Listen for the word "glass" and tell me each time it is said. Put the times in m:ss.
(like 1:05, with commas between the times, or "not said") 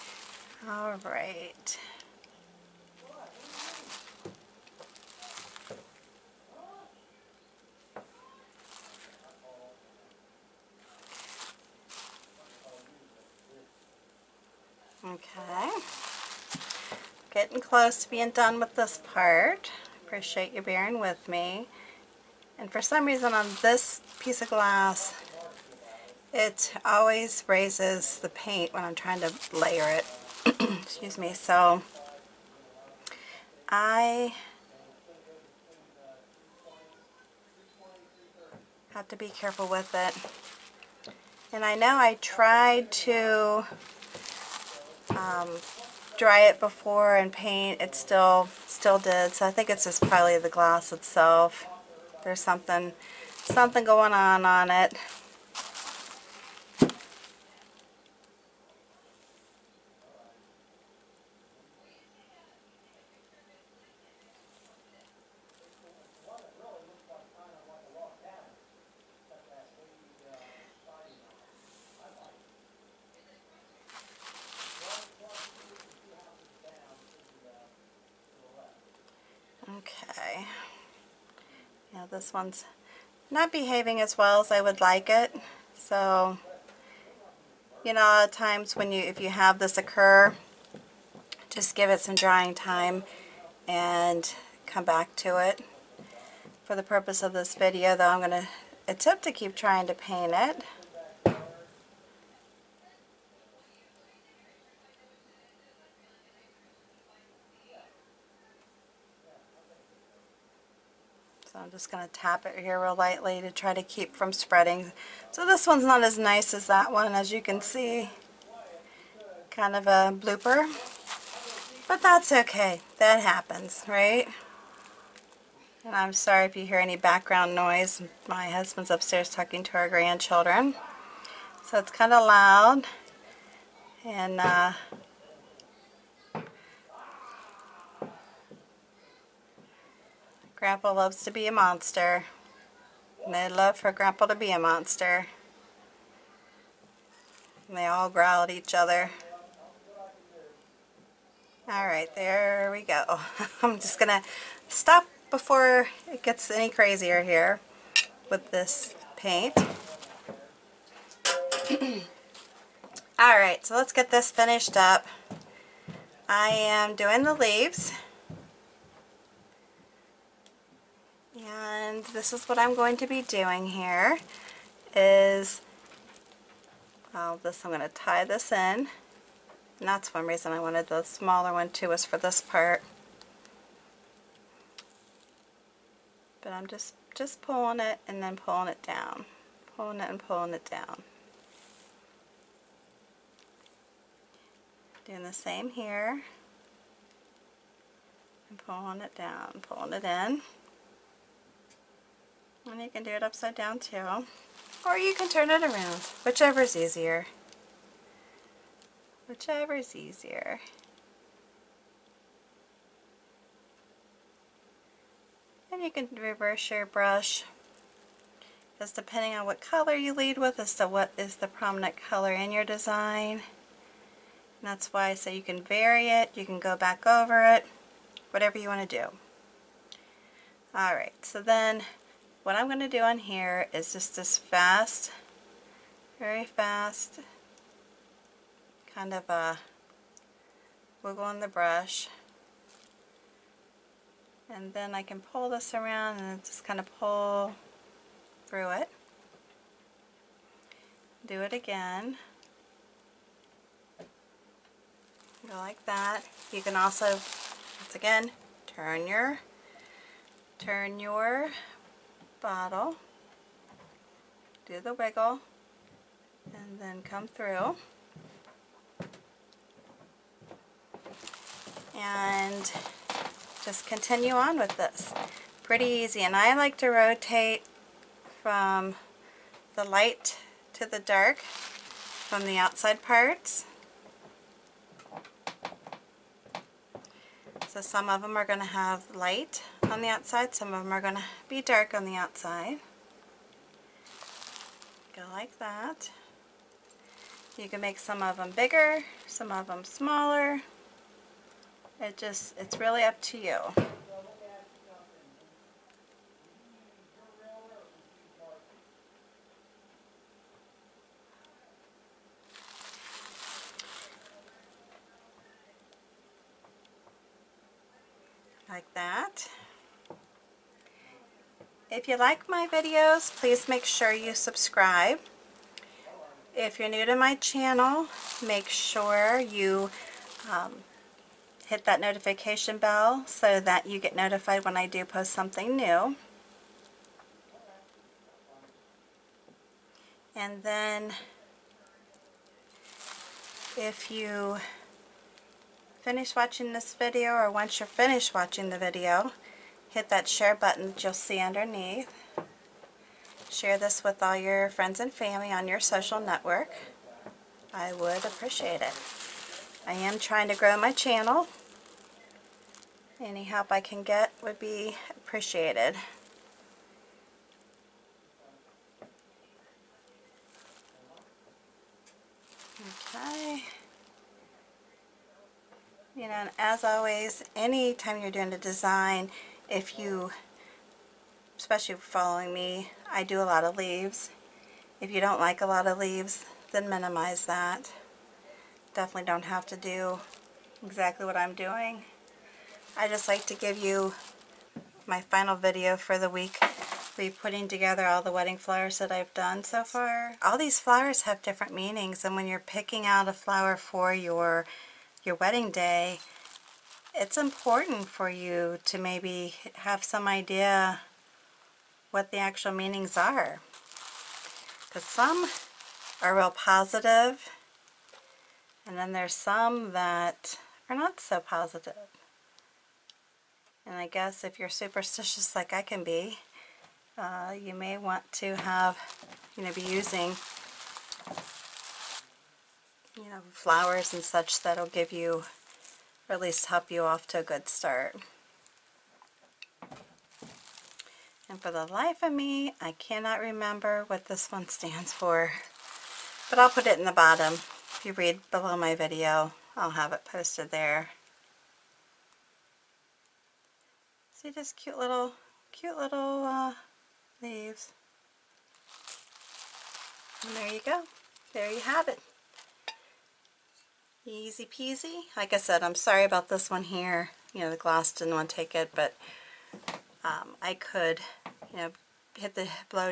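0:24, 0:50, 7:47.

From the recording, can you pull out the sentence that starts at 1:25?
So, you know, times when you, if you have this occur, just give it some drying time and come back to it.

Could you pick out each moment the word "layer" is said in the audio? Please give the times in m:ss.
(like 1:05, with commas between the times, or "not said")
0:29.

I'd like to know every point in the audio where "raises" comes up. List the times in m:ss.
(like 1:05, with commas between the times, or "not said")
0:27.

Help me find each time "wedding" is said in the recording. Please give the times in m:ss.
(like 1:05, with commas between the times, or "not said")
6:38, 6:45.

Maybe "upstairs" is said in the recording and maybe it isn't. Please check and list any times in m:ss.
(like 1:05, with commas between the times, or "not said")
2:08.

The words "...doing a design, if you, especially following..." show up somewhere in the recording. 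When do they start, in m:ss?
6:18.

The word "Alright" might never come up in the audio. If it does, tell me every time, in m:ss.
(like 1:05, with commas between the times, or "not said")
2:31, 2:43, 3:50.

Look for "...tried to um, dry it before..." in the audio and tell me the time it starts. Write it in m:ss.
0:42.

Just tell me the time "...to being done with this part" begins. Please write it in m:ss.
0:18.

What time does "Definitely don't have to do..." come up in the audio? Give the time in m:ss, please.
6:28.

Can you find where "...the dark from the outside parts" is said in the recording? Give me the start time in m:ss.
4:40.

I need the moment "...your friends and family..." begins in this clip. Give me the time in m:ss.
5:54.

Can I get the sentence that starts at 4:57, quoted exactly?
You can make some of them bigger, some of them smaller.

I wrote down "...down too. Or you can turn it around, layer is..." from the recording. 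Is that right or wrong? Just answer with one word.
wrong.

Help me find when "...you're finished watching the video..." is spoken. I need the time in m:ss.
5:47.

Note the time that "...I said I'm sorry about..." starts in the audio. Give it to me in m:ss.
7:45.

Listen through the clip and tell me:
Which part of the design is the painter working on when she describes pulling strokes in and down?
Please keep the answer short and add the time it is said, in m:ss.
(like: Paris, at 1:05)
the leaves, at 2:47.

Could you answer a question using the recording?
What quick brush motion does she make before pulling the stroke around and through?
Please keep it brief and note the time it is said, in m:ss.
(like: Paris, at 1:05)
a wiggle, at 3:59.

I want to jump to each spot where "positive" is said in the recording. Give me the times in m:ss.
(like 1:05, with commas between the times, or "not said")
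6:56, 7:01.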